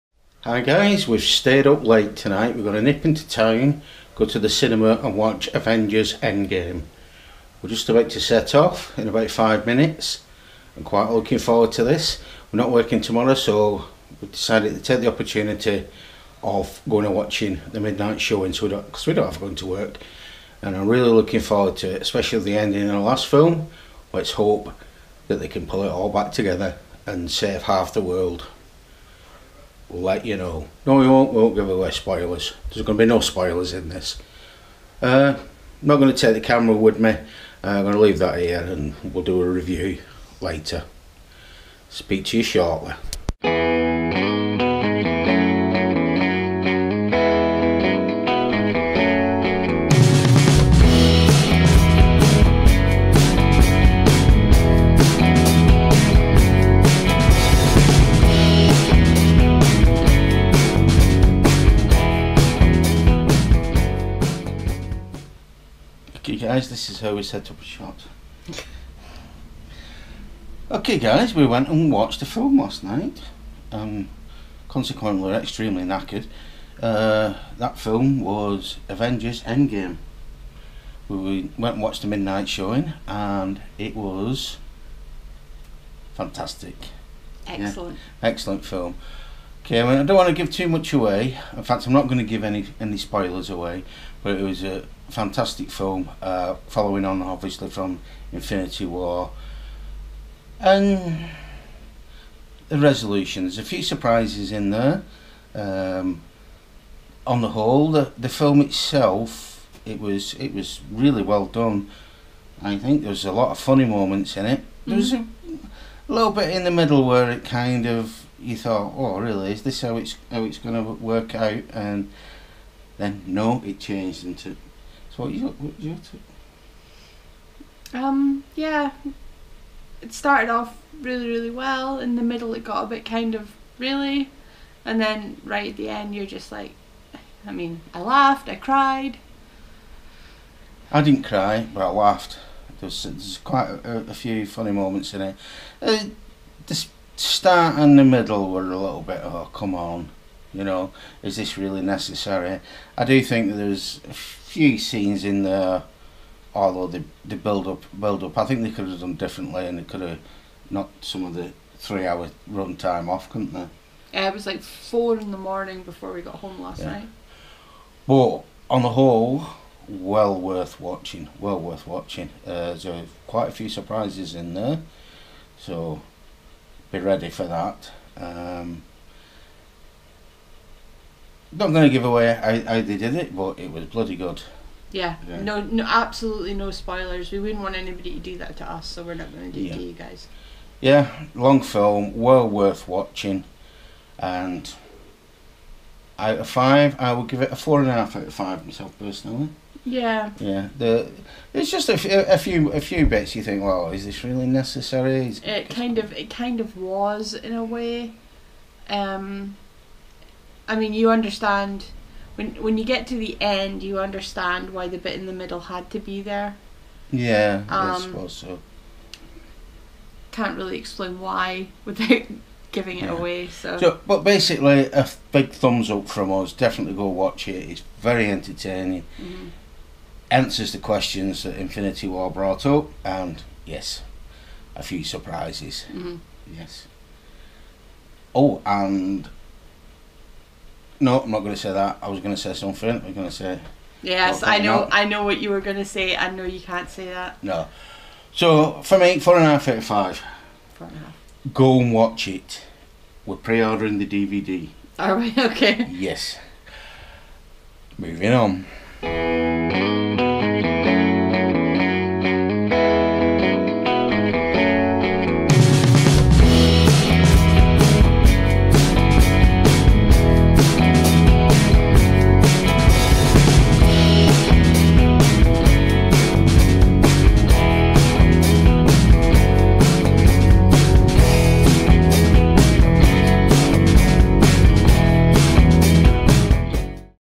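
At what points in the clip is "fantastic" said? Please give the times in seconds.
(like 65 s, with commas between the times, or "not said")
86 s, 95 s.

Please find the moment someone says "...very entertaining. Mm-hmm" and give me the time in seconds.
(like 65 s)
227 s.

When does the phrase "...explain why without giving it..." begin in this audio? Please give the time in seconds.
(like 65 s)
220 s.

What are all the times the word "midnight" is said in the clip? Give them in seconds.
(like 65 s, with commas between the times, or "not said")
17 s, 82 s.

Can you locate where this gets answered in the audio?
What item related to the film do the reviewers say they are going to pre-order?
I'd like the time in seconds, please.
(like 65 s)
253 s.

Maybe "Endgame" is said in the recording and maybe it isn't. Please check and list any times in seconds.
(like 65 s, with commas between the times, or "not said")
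6 s, 79 s.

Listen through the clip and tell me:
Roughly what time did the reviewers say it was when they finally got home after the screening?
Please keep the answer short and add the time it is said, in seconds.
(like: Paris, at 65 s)
4 in the morning, at 164 s.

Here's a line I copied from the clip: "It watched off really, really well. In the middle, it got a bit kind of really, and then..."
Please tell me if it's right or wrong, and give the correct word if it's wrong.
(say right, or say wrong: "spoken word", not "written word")
wrong: "started", not "watched".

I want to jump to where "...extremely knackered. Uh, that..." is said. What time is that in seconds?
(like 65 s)
75 s.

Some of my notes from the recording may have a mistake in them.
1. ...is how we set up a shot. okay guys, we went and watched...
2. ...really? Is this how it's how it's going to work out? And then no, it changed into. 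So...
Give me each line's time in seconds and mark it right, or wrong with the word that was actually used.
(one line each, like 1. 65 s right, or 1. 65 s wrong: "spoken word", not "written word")
1. 66 s right
2. 119 s right.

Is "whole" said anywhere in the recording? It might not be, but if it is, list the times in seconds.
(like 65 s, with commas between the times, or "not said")
107 s, 168 s.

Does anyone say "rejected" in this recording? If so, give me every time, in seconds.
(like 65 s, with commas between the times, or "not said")
not said.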